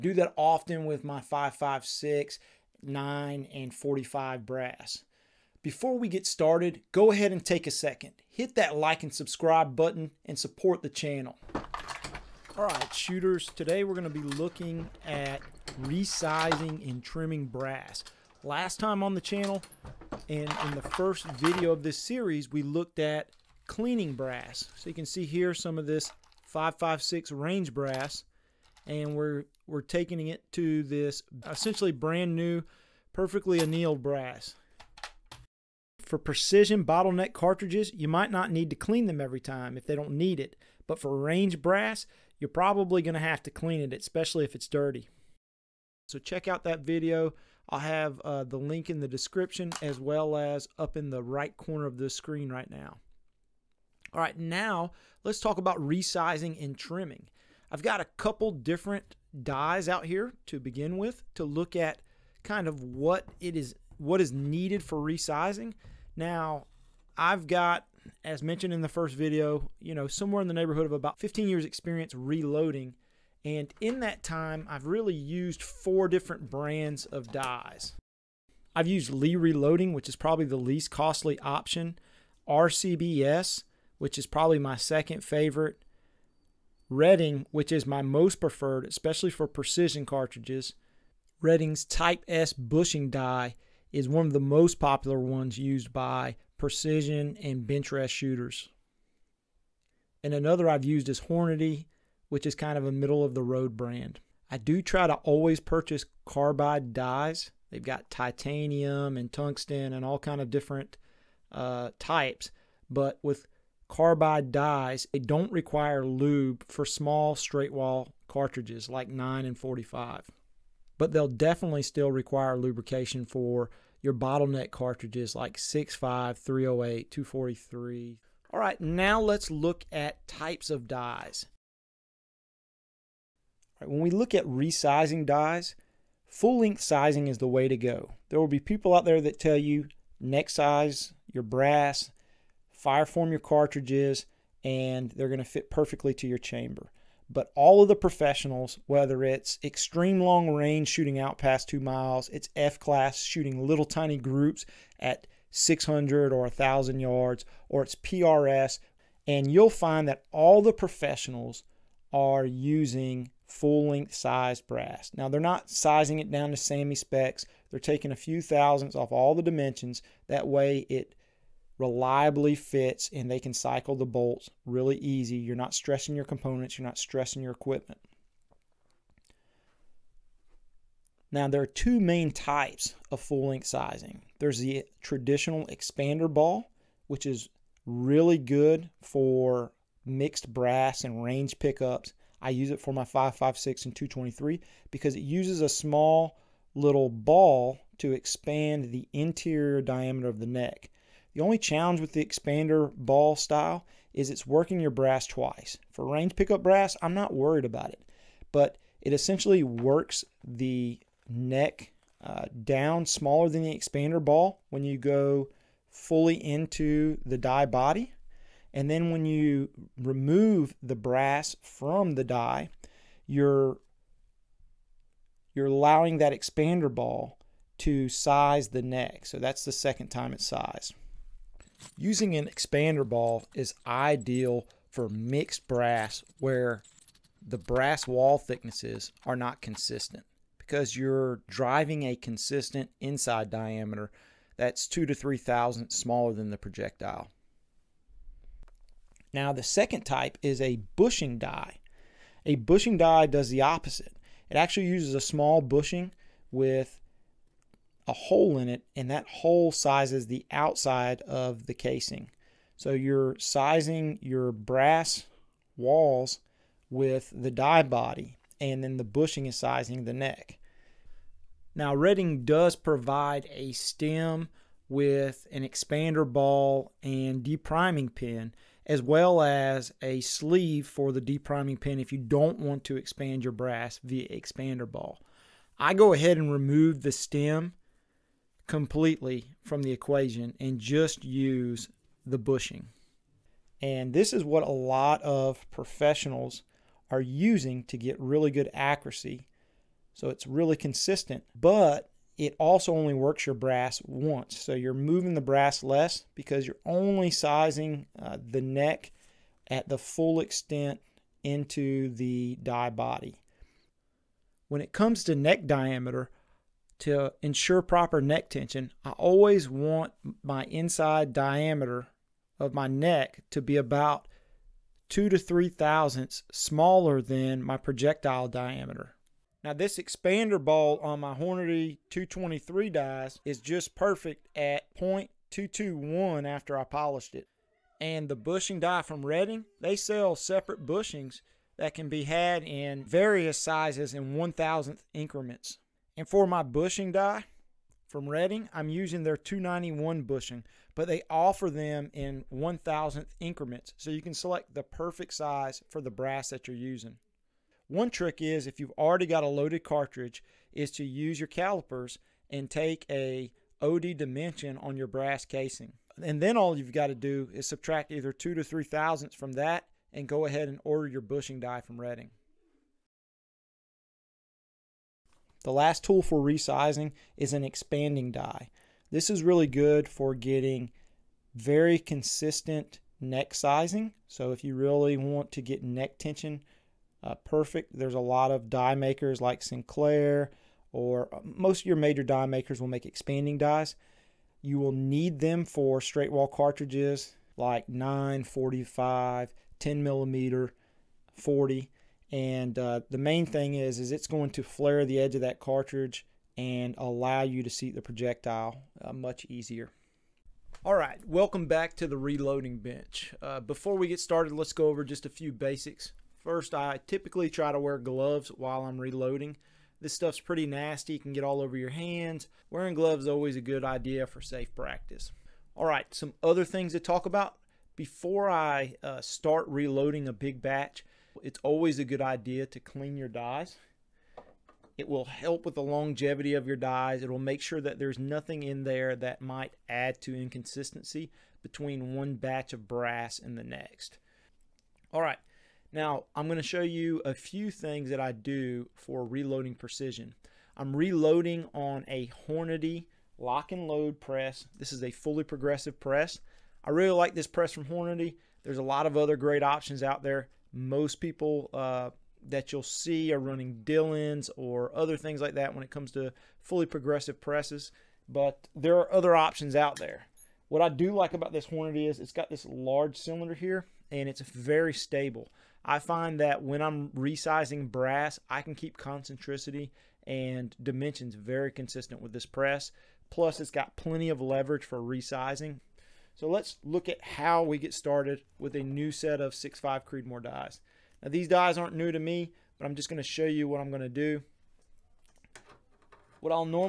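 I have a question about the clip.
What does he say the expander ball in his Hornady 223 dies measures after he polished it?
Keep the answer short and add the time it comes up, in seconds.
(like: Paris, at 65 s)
0.221, at 334 s.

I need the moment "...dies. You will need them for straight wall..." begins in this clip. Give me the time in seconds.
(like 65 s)
393 s.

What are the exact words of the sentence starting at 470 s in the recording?
What I do like about this Hornady is it's got this large cylinder here and it's very stable.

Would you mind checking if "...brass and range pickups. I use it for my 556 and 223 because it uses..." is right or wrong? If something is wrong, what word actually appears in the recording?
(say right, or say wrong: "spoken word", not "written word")
right.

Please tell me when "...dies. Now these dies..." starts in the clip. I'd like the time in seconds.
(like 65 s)
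490 s.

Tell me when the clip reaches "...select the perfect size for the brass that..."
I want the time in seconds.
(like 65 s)
354 s.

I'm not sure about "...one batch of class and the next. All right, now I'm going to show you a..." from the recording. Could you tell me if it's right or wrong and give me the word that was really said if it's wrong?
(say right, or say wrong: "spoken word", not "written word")
wrong: "brass", not "class".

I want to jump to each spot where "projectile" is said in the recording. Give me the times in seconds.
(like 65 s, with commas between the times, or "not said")
246 s, 327 s, 408 s.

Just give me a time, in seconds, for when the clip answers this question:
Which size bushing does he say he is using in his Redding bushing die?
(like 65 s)
349 s.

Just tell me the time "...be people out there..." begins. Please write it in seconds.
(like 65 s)
138 s.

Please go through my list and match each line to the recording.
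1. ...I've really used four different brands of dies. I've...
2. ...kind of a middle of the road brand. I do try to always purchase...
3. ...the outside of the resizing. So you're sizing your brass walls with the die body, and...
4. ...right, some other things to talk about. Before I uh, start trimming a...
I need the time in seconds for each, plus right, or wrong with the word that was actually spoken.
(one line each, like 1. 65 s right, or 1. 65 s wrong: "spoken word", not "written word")
1. 74 s right
2. 102 s right
3. 260 s wrong: "casing", not "resizing"
4. 425 s wrong: "reloading", not "trimming".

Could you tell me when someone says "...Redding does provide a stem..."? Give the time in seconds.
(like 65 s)
271 s.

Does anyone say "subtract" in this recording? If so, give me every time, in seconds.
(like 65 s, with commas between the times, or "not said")
367 s.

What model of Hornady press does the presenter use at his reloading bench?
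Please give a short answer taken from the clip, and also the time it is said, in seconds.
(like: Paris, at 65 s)
Lock and load, at 453 s.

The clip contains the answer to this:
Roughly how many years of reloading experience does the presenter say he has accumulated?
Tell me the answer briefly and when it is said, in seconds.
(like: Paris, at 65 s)
15 years, at 71 s.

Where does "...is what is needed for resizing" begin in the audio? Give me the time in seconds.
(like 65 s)
63 s.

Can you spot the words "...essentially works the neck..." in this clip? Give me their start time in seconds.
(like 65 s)
209 s.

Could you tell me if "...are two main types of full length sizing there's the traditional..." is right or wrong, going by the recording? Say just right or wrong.
right.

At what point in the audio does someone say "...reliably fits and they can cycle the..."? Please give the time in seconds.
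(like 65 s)
171 s.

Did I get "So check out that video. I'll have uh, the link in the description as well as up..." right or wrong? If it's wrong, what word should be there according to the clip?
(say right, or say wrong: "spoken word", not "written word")
right.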